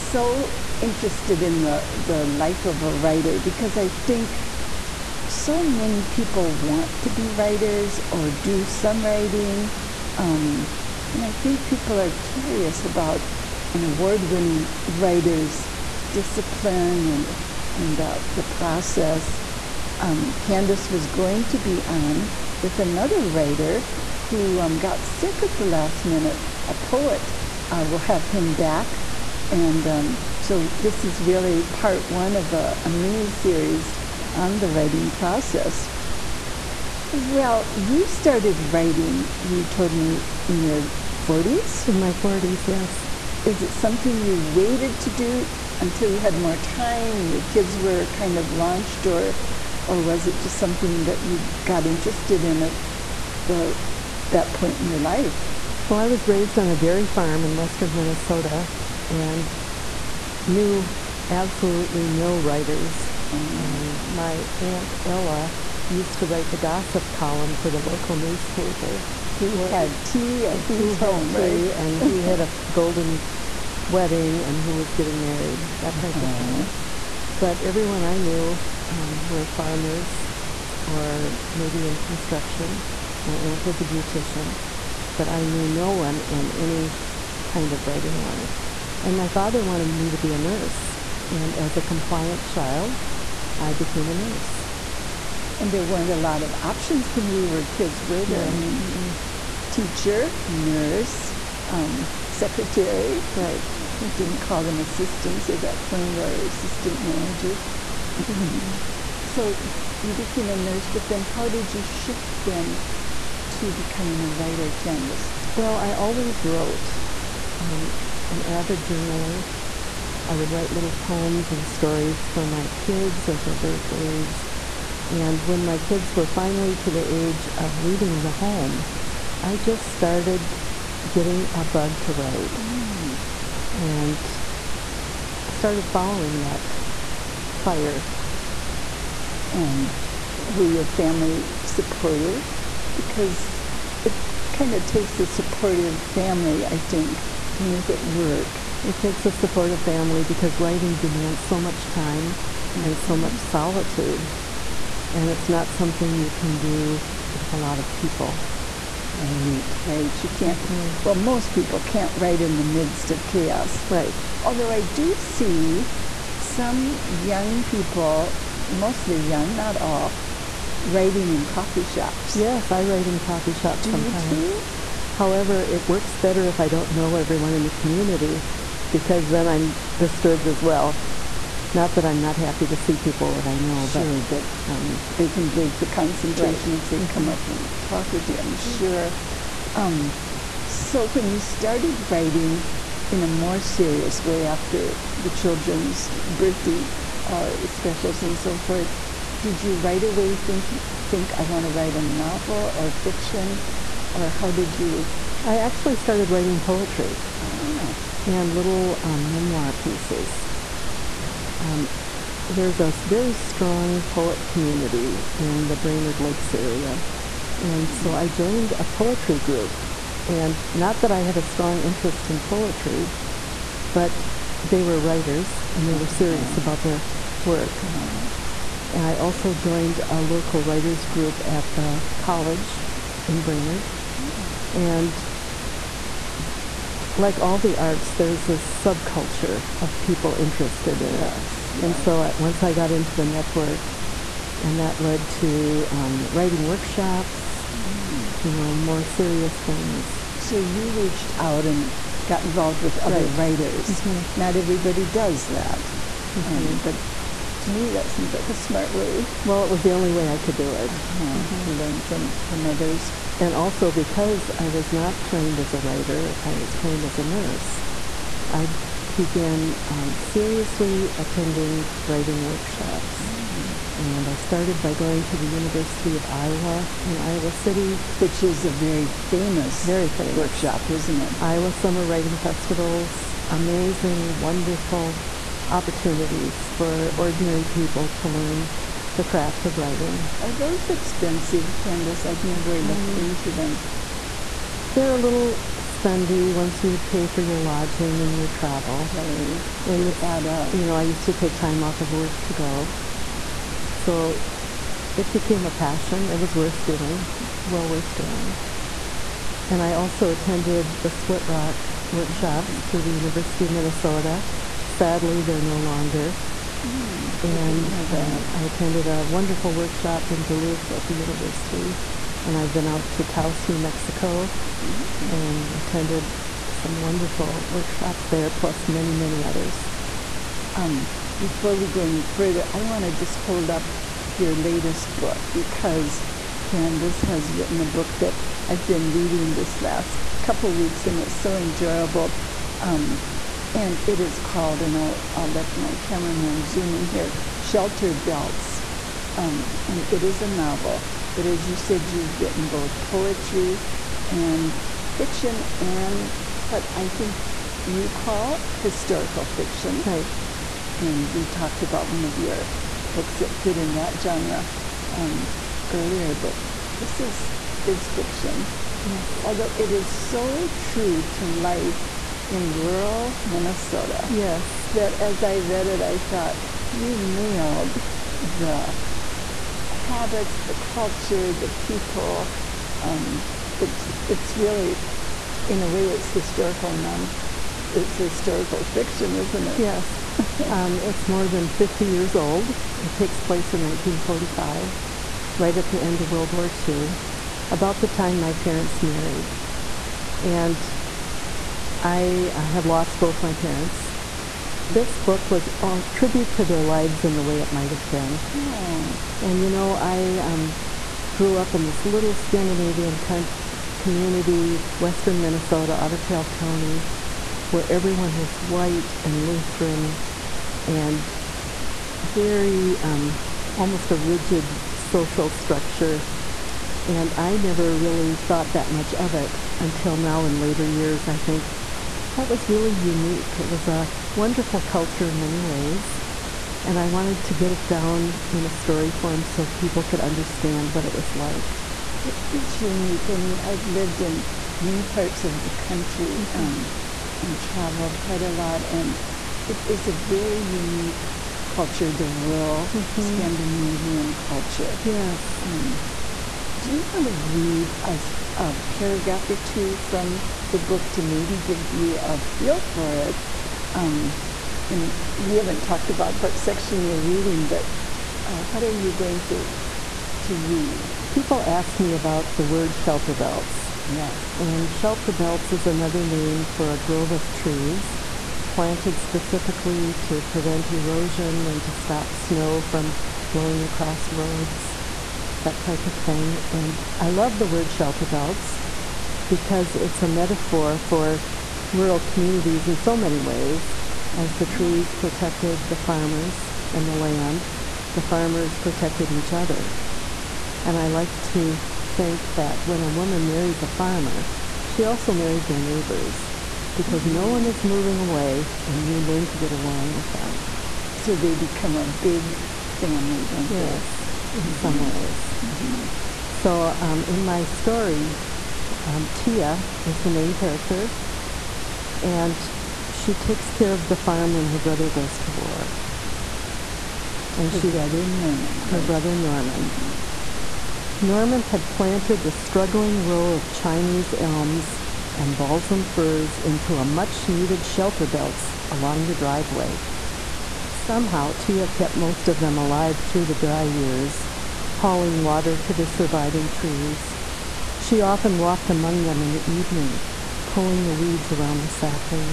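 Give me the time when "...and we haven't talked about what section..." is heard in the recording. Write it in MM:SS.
07:44.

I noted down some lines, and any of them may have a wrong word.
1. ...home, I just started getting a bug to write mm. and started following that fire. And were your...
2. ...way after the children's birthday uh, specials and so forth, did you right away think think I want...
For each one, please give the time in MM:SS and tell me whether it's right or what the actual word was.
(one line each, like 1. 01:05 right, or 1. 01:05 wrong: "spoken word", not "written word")
1. 02:08 right
2. 03:14 right.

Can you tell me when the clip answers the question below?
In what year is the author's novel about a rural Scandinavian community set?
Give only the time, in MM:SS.
06:33.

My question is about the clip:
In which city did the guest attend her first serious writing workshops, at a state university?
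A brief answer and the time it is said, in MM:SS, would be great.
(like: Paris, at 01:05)
Iowa City, at 04:37.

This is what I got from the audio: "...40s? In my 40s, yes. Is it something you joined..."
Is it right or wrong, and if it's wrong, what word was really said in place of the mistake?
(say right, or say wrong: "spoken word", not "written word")
wrong: "waited", not "joined".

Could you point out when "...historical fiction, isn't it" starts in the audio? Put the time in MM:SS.
06:28.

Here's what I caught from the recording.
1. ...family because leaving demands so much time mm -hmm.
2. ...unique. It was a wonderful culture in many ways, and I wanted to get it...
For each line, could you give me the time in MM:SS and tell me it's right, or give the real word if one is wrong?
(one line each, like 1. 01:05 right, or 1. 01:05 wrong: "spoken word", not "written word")
1. 02:29 wrong: "writing", not "leaving"
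2. 07:12 right.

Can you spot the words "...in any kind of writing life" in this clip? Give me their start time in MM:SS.
01:26.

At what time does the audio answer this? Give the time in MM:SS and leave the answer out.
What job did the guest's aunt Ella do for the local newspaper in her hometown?
01:06.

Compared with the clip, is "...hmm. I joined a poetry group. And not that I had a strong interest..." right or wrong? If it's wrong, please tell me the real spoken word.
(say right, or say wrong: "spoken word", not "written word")
right.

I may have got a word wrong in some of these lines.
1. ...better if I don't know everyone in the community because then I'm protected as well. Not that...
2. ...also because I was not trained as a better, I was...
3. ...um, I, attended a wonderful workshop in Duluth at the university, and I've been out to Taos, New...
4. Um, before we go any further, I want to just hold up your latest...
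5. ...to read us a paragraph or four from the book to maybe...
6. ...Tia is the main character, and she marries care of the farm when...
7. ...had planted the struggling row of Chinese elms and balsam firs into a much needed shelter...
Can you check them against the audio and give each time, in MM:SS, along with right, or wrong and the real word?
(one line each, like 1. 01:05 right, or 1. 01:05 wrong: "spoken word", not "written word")
1. 02:56 wrong: "disturbed", not "protected"
2. 04:23 wrong: "writer", not "better"
3. 05:18 right
4. 05:30 right
5. 07:37 wrong: "two", not "four"
6. 08:39 wrong: "takes", not "marries"
7. 08:51 right.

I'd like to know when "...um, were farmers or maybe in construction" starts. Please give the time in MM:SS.
01:18.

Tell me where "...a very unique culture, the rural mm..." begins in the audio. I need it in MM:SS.
07:30.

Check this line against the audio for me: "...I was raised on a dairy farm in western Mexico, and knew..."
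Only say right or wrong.
wrong.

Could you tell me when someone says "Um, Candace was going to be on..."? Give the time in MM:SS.
00:20.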